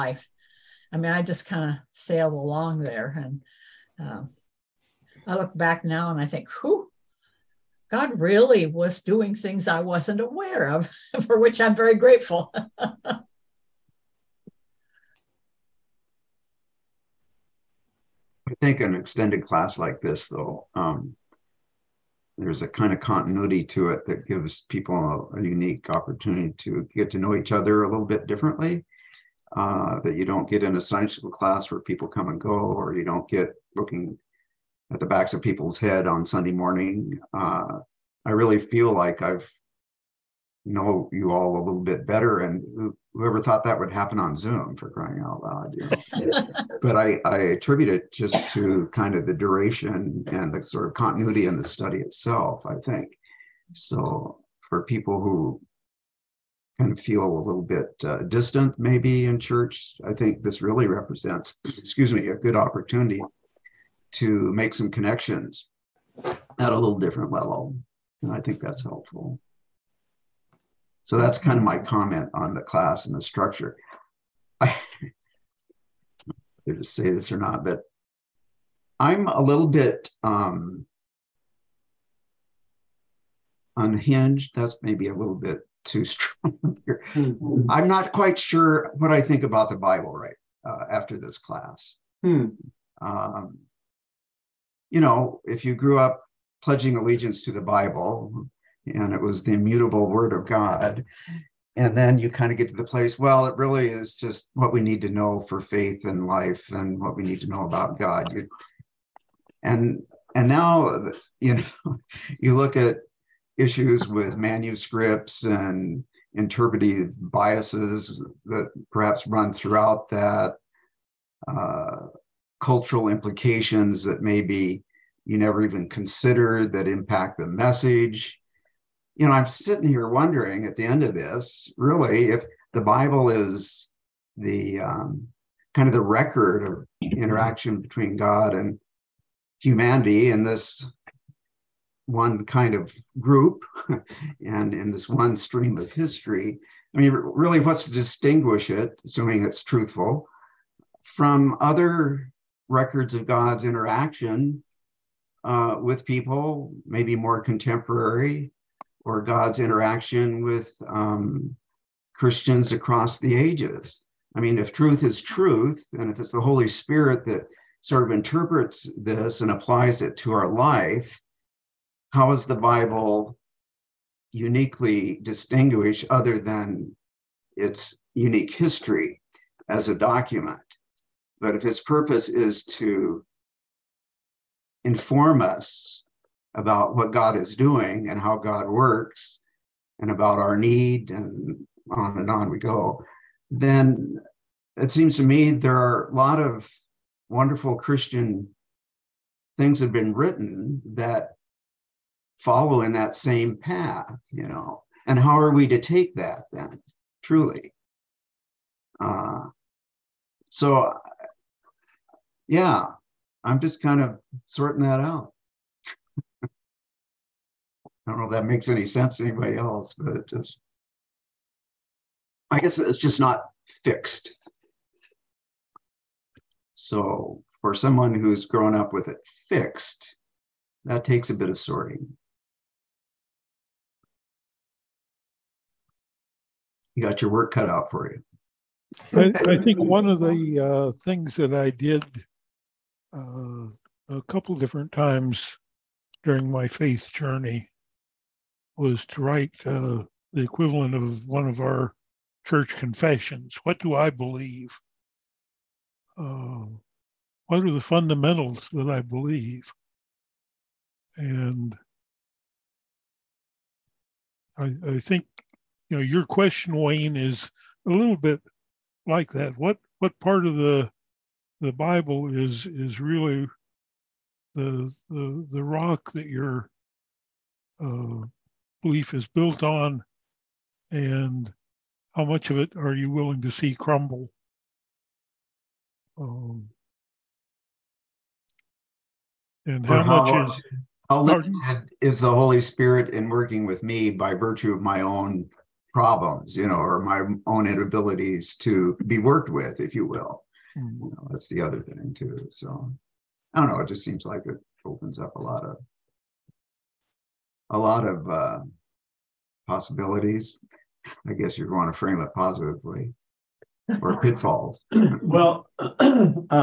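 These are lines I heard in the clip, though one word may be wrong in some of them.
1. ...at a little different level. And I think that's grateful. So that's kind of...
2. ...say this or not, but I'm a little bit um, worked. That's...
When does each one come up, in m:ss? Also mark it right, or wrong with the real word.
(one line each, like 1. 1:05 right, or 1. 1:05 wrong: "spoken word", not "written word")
1. 1:06 wrong: "helpful", not "grateful"
2. 1:16 wrong: "unhinged", not "worked".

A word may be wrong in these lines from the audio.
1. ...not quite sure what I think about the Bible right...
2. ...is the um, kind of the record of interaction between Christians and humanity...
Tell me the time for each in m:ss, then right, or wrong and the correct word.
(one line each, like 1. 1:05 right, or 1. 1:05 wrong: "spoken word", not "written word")
1. 1:27 right
2. 2:13 wrong: "God", not "Christians".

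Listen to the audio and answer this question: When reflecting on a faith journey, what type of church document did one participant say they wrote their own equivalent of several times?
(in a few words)
confessions.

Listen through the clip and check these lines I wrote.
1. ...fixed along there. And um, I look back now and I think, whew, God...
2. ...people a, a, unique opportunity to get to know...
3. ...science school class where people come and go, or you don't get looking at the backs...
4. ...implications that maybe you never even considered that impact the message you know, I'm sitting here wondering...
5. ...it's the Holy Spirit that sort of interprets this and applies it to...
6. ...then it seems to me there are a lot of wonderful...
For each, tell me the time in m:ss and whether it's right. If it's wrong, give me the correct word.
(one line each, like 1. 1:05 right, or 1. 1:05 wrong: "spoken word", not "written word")
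1. 0:01 wrong: "sailed", not "fixed"
2. 0:24 right
3. 0:30 right
4. 2:03 right
5. 2:46 right
6. 3:13 right.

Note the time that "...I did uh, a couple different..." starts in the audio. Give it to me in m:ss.
4:01.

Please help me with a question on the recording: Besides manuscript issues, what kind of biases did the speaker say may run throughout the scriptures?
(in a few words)
interpretive biases.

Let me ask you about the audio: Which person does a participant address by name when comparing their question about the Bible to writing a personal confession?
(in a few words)
Wayne.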